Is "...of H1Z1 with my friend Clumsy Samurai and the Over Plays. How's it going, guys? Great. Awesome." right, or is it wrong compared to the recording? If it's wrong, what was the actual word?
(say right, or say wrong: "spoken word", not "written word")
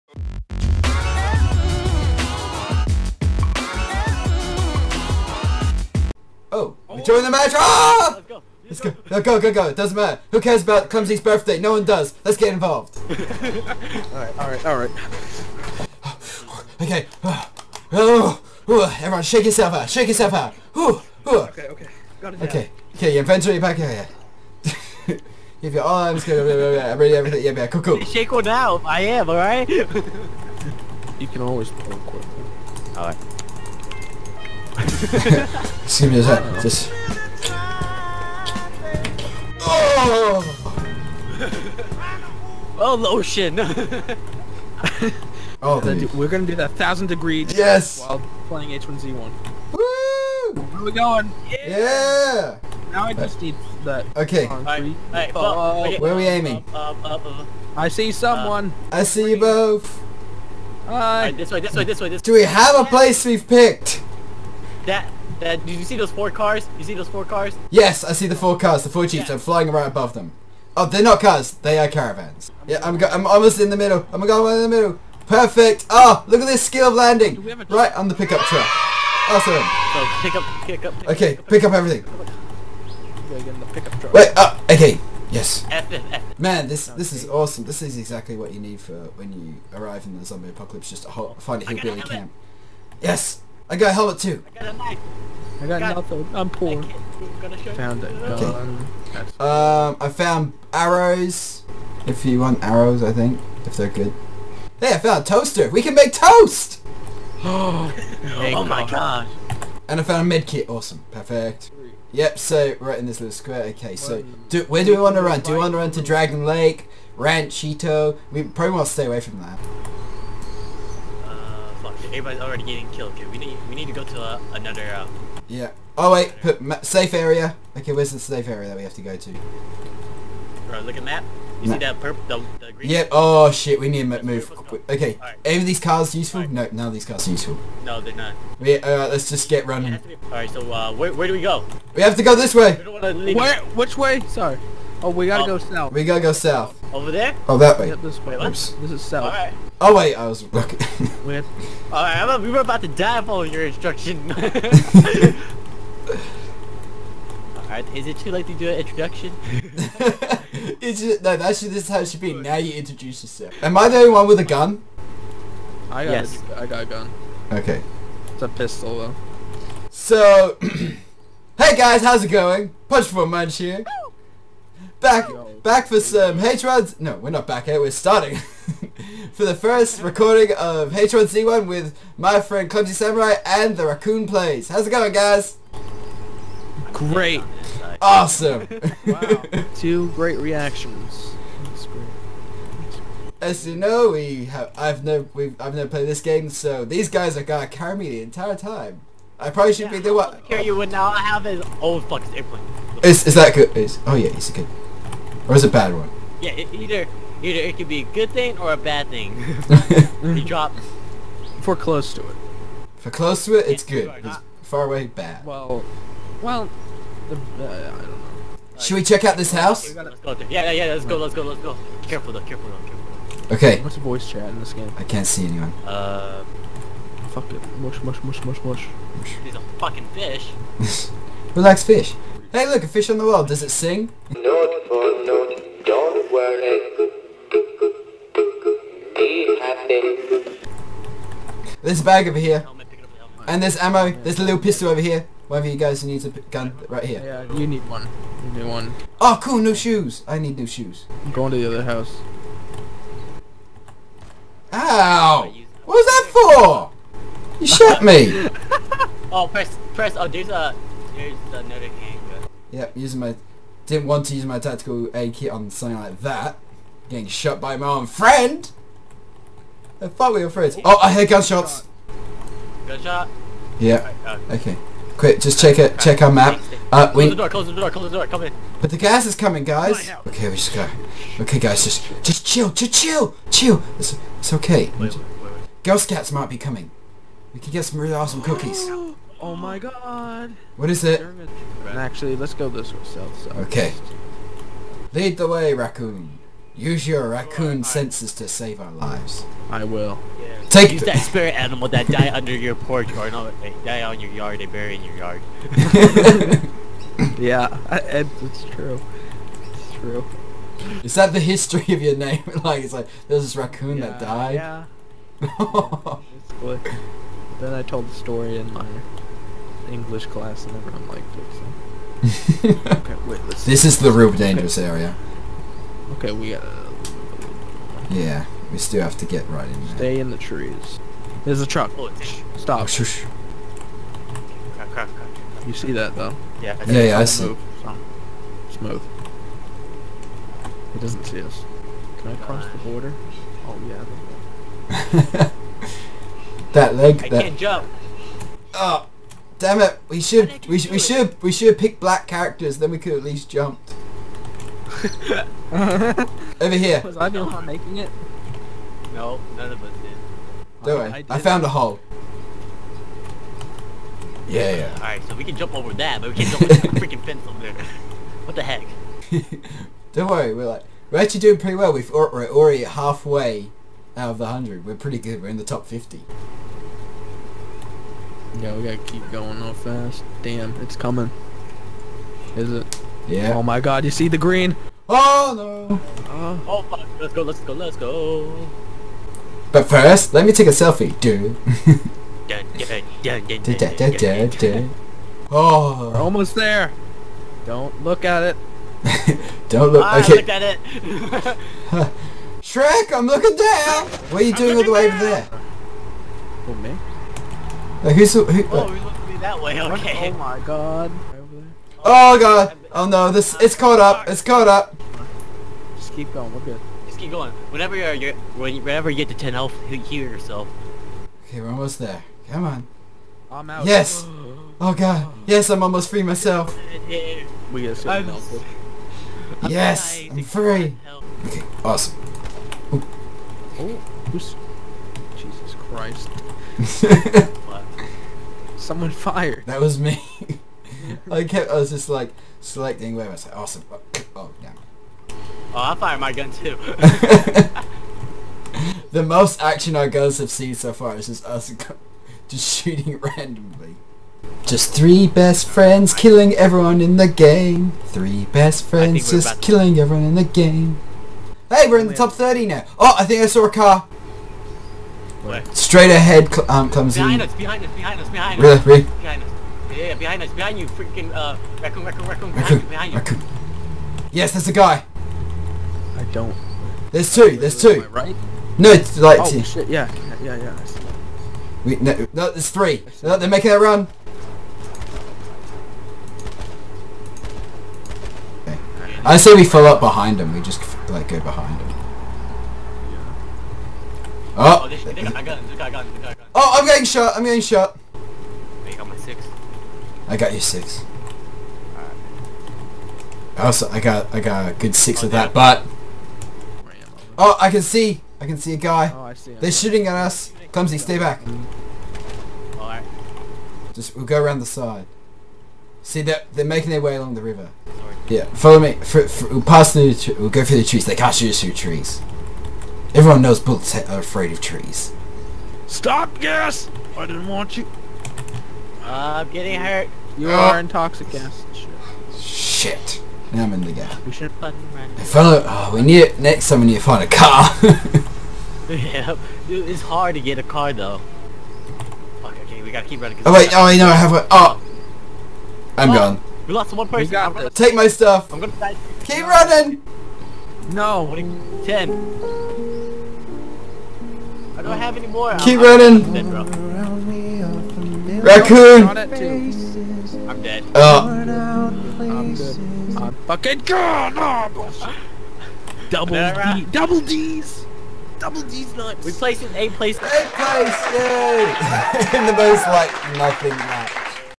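wrong: "Raccoon", not "Over".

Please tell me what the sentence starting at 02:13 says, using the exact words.
Oh shit, we need to move.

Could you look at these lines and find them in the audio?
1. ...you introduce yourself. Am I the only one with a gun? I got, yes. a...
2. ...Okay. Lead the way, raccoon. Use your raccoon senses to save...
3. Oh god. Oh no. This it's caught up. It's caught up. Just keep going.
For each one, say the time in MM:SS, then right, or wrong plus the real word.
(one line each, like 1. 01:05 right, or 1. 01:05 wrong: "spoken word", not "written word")
1. 02:42 right
2. 04:53 right
3. 06:52 right.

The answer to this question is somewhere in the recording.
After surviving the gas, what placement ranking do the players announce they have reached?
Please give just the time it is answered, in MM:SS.
07:42.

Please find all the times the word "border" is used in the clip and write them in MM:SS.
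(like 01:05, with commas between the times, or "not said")
05:42.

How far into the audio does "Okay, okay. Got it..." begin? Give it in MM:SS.
00:21.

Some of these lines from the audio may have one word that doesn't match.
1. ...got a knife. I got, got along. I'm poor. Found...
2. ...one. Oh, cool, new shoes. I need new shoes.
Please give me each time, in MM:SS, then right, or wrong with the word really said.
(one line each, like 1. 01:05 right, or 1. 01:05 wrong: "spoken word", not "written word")
1. 01:34 wrong: "nothing", not "along"
2. 04:08 right.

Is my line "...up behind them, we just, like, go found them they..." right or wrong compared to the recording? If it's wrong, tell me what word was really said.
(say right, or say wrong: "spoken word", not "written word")
wrong: "behind", not "found".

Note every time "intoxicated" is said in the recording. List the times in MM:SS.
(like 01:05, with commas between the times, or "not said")
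08:50.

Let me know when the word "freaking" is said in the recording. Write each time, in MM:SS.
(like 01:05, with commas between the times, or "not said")
06:06, 07:50.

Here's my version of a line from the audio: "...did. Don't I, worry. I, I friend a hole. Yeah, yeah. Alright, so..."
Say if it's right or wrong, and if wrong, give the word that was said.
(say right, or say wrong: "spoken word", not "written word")
wrong: "found", not "friend".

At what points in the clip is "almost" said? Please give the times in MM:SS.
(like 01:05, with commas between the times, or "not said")
01:13, 06:36, 07:01, 07:05.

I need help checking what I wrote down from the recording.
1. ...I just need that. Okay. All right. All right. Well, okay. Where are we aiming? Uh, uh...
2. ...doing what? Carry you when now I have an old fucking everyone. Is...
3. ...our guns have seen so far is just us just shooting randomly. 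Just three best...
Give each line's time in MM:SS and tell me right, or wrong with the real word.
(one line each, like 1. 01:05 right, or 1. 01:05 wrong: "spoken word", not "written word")
1. 00:53 right
2. 03:20 wrong: "airplane", not "everyone"
3. 07:29 right.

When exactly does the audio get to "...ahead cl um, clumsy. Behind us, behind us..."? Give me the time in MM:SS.
07:46.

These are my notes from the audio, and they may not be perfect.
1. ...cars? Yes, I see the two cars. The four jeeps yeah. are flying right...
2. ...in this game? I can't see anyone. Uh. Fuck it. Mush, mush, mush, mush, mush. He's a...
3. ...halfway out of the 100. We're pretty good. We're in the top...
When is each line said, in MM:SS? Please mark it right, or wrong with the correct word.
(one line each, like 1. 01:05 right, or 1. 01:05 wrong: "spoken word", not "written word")
1. 01:07 wrong: "four", not "two"
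2. 03:44 right
3. 06:12 right.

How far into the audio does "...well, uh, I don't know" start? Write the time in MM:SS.
03:36.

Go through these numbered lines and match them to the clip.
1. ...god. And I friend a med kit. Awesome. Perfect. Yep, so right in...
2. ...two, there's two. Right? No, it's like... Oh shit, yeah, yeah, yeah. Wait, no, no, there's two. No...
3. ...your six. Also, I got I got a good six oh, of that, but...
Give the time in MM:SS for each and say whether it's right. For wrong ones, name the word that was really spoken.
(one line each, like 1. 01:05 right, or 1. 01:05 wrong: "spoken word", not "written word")
1. 01:48 wrong: "found", not "friend"
2. 07:57 wrong: "three", not "two"
3. 08:20 right.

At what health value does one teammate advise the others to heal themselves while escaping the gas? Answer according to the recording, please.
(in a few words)
10.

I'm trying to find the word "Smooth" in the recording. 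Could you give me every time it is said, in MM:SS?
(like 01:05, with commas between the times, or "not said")
05:38.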